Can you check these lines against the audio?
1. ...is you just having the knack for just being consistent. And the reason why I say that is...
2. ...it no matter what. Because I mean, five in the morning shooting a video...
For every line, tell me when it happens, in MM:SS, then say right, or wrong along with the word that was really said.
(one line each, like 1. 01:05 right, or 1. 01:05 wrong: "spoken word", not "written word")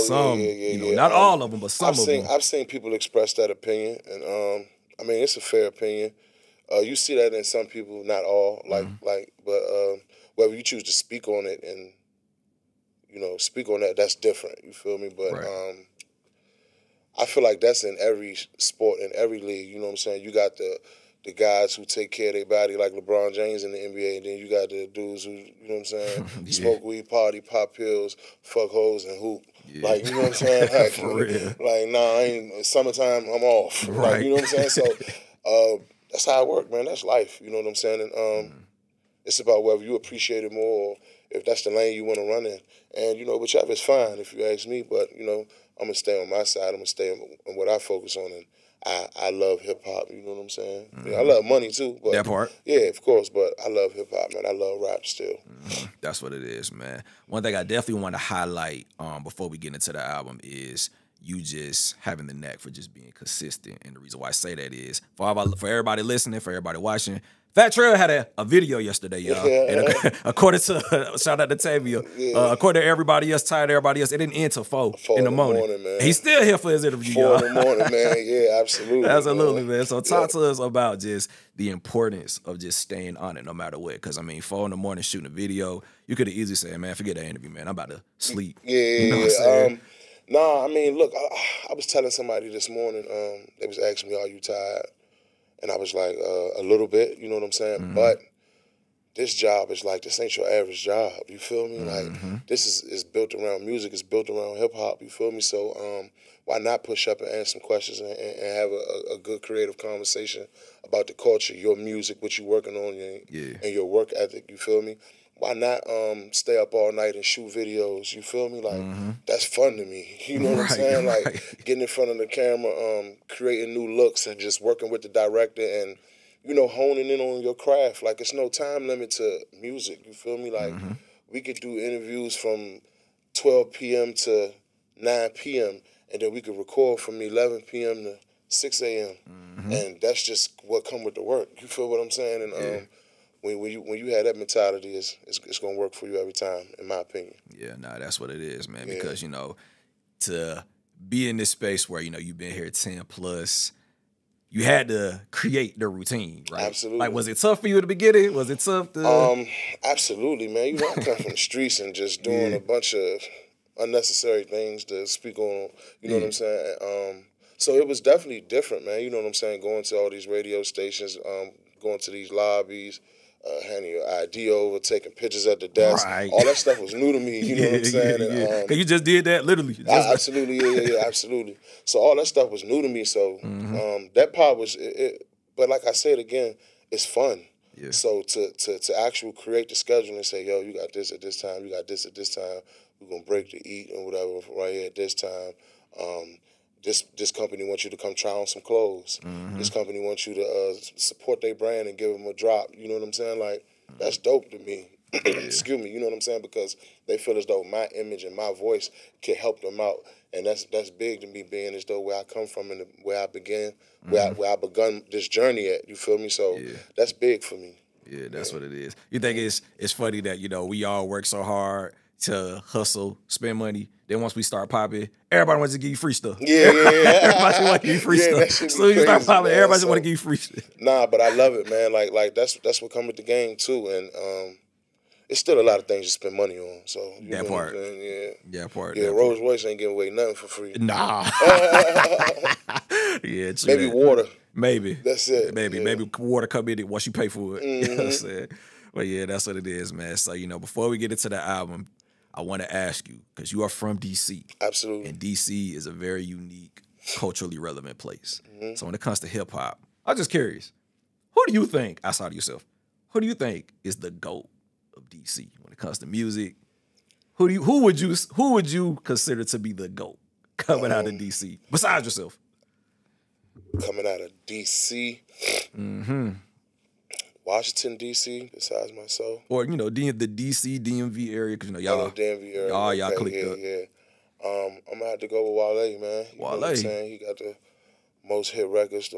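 1. 01:00 right
2. 01:23 wrong: "four", not "five".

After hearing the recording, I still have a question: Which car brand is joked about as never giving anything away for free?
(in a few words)
Rolls Royce.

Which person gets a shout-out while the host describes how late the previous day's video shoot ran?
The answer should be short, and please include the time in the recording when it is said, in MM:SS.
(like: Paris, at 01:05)
Tavia, at 01:11.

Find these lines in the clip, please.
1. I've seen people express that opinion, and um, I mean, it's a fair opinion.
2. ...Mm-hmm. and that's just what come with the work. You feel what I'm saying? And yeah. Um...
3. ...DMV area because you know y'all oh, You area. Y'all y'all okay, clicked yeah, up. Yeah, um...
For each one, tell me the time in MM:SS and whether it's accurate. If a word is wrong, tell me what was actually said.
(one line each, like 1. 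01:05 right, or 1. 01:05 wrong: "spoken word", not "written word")
1. 00:02 right
2. 02:19 right
3. 04:40 wrong: "DMV", not "You".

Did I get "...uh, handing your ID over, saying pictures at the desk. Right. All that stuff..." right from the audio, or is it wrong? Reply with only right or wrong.
wrong.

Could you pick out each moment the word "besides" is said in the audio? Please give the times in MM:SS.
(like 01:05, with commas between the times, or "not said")
04:31, 04:38.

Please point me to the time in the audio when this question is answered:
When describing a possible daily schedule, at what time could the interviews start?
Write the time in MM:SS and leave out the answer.
02:13.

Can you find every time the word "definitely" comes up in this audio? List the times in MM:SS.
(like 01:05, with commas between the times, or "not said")
00:57, 02:47.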